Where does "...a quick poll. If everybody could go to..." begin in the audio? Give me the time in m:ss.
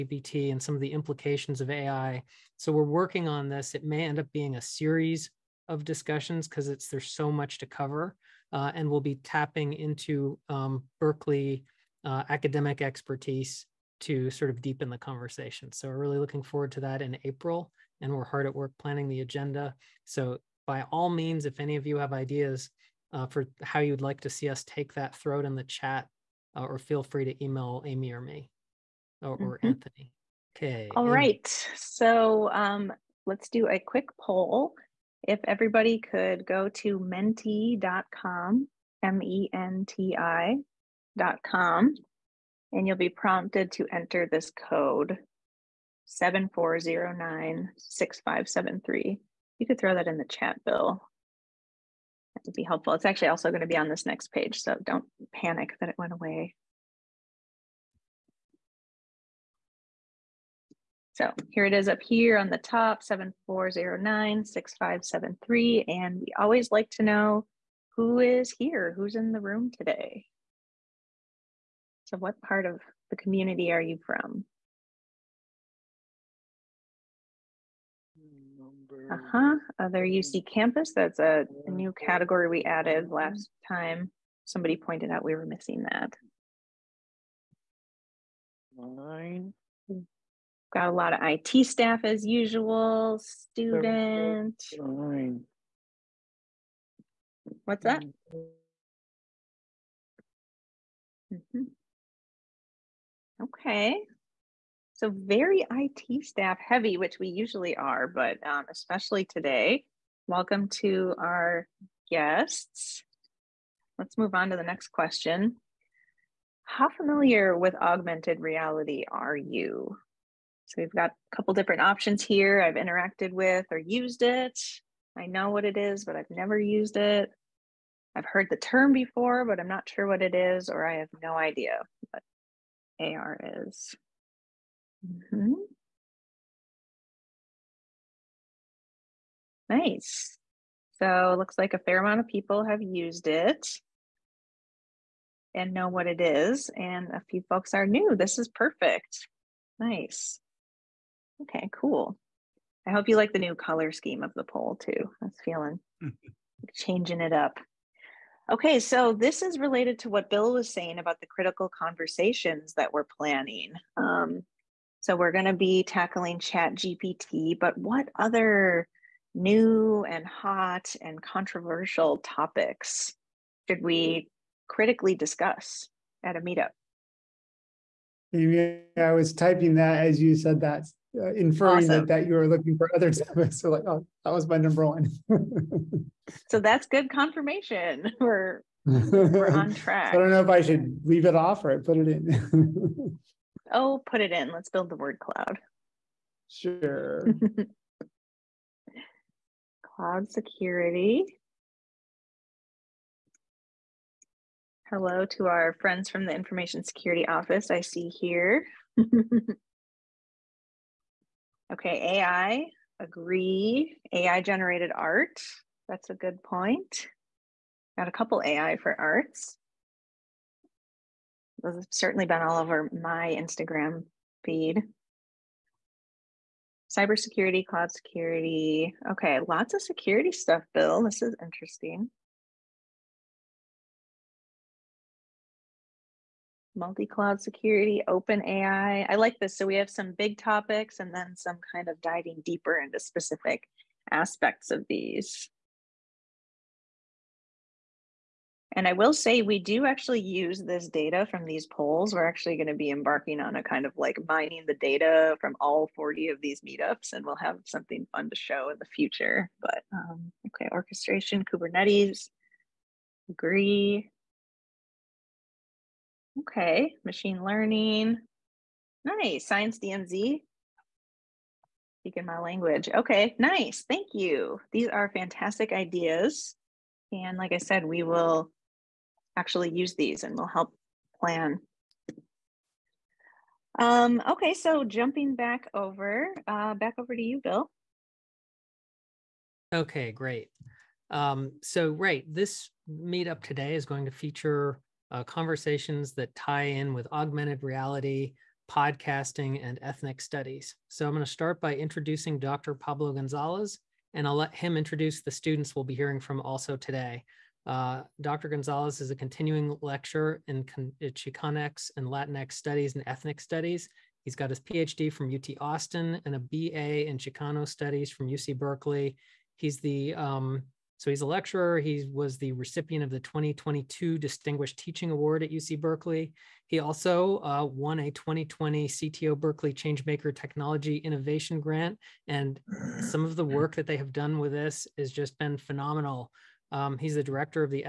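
0:33.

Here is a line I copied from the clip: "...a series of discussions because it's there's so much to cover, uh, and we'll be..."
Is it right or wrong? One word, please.
right.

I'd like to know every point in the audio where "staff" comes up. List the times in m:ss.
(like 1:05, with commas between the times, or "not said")
1:31, 1:46.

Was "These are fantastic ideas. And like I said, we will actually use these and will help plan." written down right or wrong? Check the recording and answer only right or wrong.
right.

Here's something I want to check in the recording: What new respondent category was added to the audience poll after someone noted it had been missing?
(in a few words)
Other UC campus.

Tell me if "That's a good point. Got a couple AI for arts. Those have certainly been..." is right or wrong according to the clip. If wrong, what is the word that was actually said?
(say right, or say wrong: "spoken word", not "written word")
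right.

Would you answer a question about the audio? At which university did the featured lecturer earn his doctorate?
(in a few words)
UT Austin.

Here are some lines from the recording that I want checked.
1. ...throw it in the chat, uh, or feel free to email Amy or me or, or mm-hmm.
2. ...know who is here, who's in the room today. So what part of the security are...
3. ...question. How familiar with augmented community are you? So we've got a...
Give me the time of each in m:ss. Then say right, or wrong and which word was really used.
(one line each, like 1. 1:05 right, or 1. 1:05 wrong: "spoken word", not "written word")
1. 0:25 right
2. 1:07 wrong: "community", not "security"
3. 1:54 wrong: "reality", not "community".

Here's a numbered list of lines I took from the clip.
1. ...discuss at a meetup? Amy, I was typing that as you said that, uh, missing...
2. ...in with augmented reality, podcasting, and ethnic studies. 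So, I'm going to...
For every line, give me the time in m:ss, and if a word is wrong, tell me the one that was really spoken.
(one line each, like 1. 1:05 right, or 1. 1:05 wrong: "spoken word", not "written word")
1. 2:55 wrong: "inferring", not "missing"
2. 4:56 right.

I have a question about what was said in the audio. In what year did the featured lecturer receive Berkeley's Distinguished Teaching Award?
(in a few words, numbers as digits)
2022.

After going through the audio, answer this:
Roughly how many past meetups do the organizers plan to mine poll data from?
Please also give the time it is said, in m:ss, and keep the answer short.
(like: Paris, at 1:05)
40, at 4:15.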